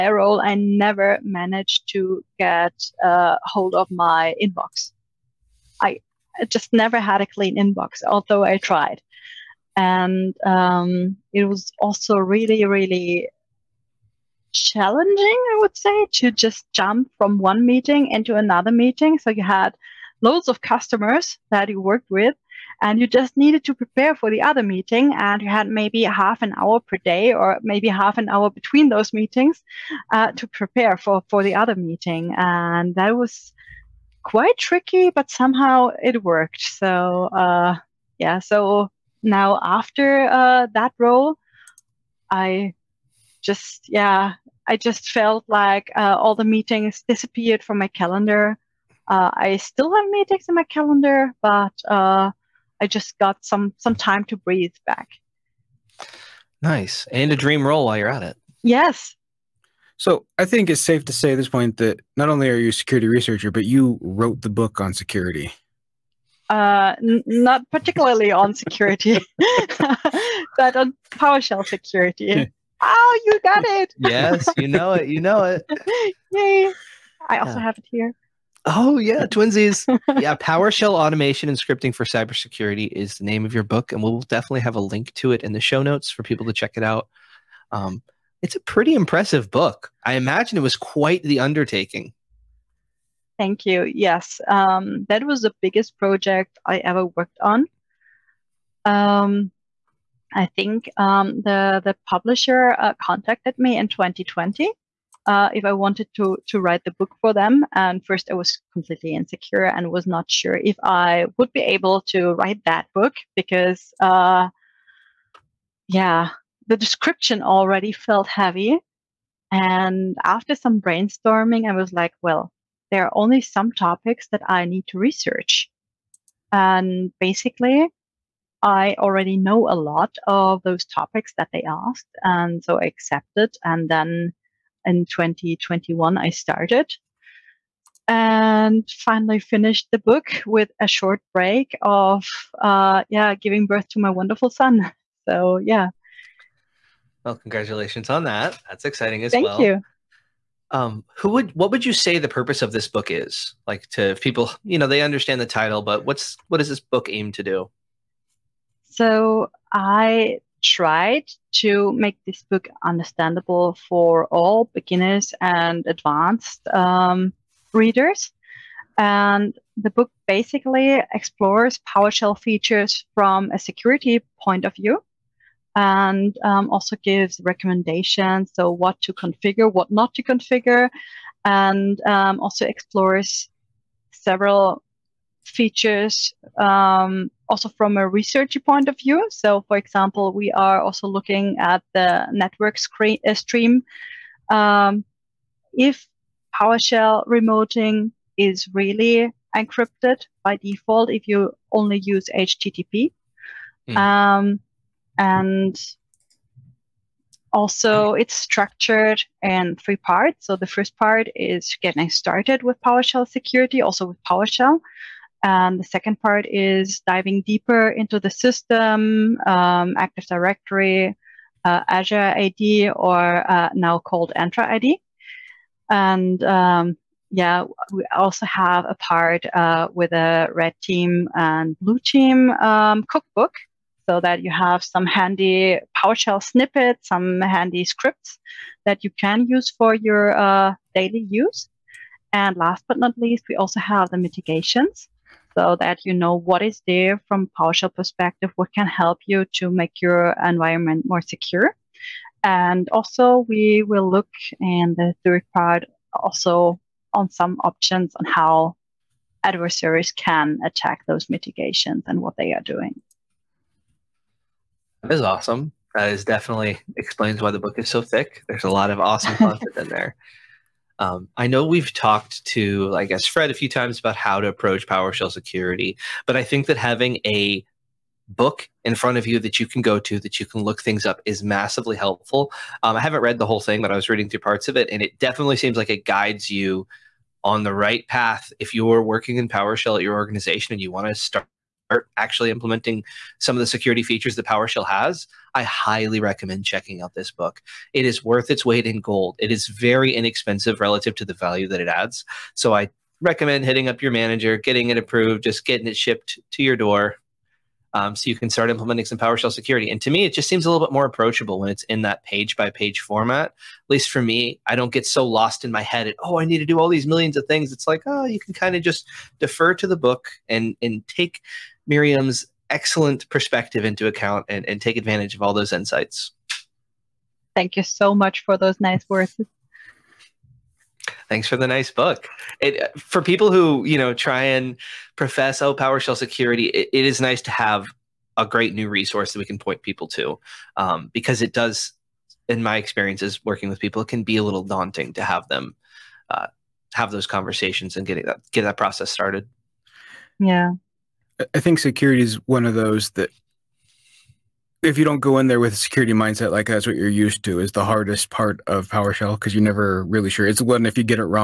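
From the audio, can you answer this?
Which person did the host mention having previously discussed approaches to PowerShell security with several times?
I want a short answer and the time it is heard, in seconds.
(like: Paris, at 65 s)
Fred, at 273 s.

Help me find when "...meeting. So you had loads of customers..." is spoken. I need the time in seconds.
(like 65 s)
18 s.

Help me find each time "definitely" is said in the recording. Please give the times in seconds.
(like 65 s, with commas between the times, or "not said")
84 s, 266 s, 285 s.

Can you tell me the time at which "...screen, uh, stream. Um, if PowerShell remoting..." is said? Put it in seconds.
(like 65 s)
192 s.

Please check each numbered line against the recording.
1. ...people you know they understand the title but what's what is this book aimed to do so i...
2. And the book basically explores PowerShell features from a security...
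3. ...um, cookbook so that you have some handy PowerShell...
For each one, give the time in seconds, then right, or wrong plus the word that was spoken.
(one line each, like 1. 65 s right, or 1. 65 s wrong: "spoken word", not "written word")
1. 154 s right
2. 168 s right
3. 232 s right.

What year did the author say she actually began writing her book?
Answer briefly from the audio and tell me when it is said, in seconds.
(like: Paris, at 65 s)
2021, at 135 s.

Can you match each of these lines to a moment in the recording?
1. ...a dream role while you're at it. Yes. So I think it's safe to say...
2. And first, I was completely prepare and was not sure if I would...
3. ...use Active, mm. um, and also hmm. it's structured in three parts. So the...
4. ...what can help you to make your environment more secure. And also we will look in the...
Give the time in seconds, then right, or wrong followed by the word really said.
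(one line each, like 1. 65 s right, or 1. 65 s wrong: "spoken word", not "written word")
1. 57 s right
2. 107 s wrong: "insecure", not "prepare"
3. 201 s wrong: "HTTP", not "Active"
4. 248 s right.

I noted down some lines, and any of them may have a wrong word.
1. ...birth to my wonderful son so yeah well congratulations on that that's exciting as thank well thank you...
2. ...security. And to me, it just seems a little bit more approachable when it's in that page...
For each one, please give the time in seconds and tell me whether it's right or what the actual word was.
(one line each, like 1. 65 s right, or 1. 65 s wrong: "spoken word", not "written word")
1. 143 s right
2. 309 s right.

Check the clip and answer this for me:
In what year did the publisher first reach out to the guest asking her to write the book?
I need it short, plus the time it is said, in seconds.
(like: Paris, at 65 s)
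2020, at 103 s.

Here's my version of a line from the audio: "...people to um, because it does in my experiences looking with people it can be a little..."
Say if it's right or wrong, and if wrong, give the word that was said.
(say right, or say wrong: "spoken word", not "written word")
wrong: "working", not "looking".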